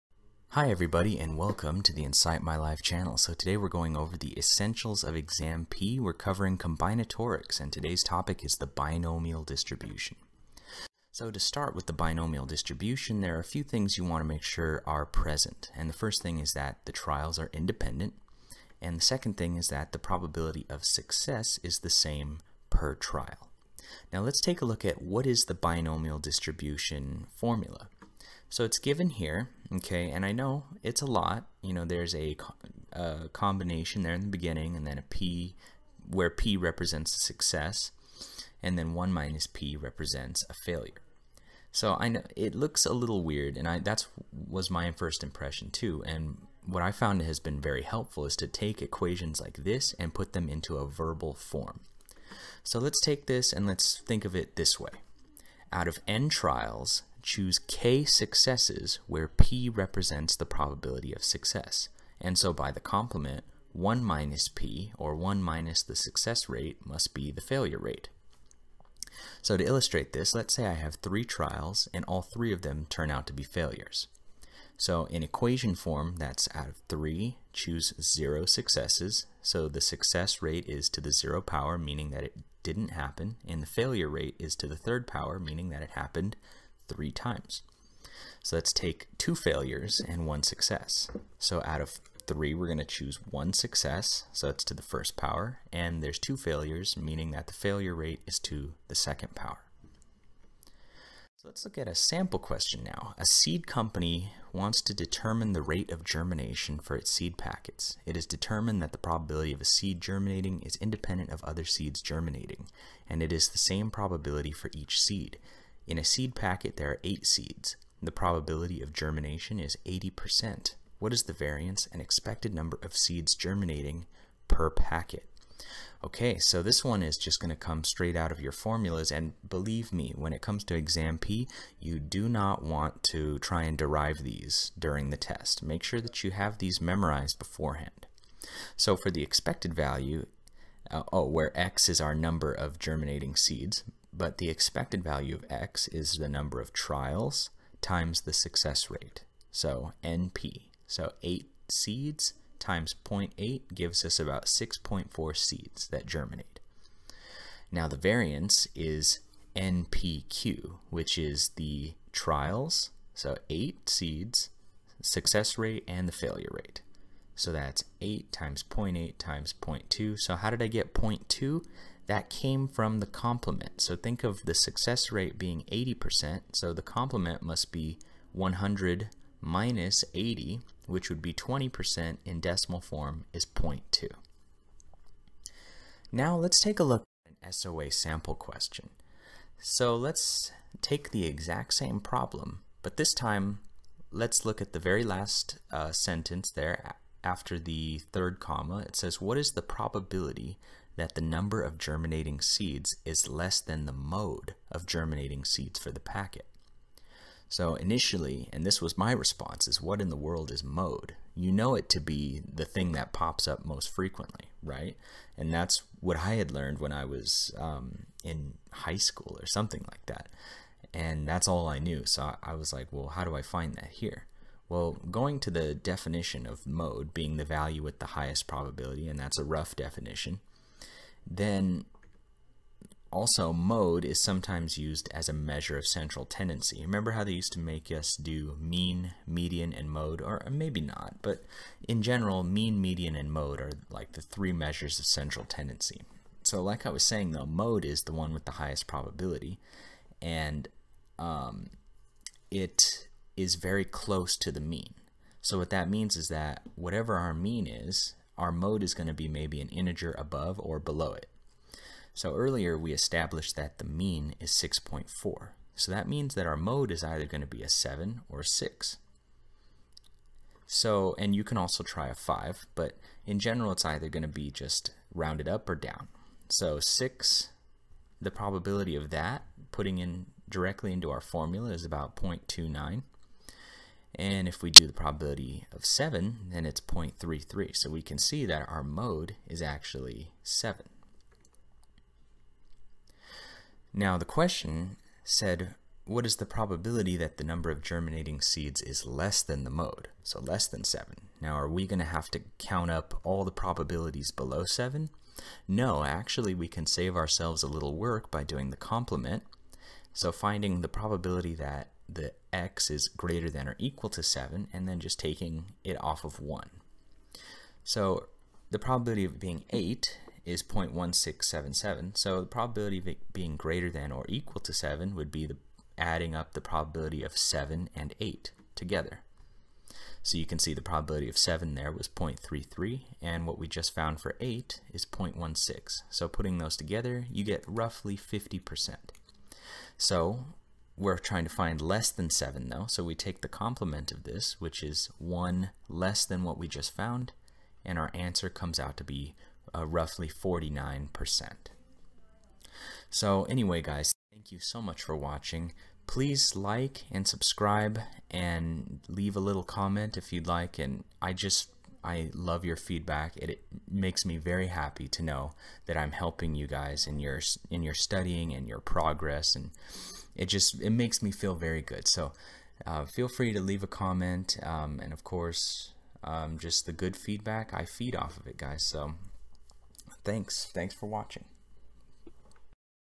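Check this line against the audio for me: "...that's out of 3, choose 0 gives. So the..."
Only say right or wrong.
wrong.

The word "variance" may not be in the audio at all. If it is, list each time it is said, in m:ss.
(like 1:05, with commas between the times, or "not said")
2:01, 2:37.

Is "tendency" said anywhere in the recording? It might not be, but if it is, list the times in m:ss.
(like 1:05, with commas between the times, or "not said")
3:56, 4:05.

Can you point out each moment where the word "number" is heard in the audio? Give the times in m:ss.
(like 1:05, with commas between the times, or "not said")
2:02, 2:22, 2:26, 3:21, 4:57.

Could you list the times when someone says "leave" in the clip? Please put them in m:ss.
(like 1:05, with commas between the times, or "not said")
5:59, 6:13.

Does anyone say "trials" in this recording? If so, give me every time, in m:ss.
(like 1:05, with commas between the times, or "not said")
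0:16, 0:22, 0:56, 1:11, 2:26, 2:42.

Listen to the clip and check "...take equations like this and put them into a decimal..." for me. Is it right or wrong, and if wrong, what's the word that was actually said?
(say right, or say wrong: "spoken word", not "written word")
wrong: "verbal", not "decimal".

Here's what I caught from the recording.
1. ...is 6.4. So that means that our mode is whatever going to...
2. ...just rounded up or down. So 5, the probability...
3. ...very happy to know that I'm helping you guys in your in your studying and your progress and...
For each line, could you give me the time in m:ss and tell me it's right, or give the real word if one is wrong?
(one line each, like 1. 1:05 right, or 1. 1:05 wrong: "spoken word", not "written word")
1. 4:24 wrong: "either", not "whatever"
2. 4:34 wrong: "6", not "5"
3. 6:04 right.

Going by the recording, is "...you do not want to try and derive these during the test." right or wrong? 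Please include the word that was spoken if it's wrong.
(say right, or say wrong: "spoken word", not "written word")
right.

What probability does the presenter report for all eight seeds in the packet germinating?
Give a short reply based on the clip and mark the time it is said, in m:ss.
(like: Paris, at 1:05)
0.1677, at 5:20.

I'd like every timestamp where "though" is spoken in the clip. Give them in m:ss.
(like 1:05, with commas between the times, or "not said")
4:07, 5:42.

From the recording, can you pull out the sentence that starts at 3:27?
So initially, and this was my response, is what in the world is mode?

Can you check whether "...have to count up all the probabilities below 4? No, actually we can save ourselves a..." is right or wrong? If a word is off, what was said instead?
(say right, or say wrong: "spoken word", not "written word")
wrong: "7", not "4".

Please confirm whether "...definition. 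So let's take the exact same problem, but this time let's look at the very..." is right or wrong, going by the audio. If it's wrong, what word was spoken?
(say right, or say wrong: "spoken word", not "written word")
wrong: "question", not "definition".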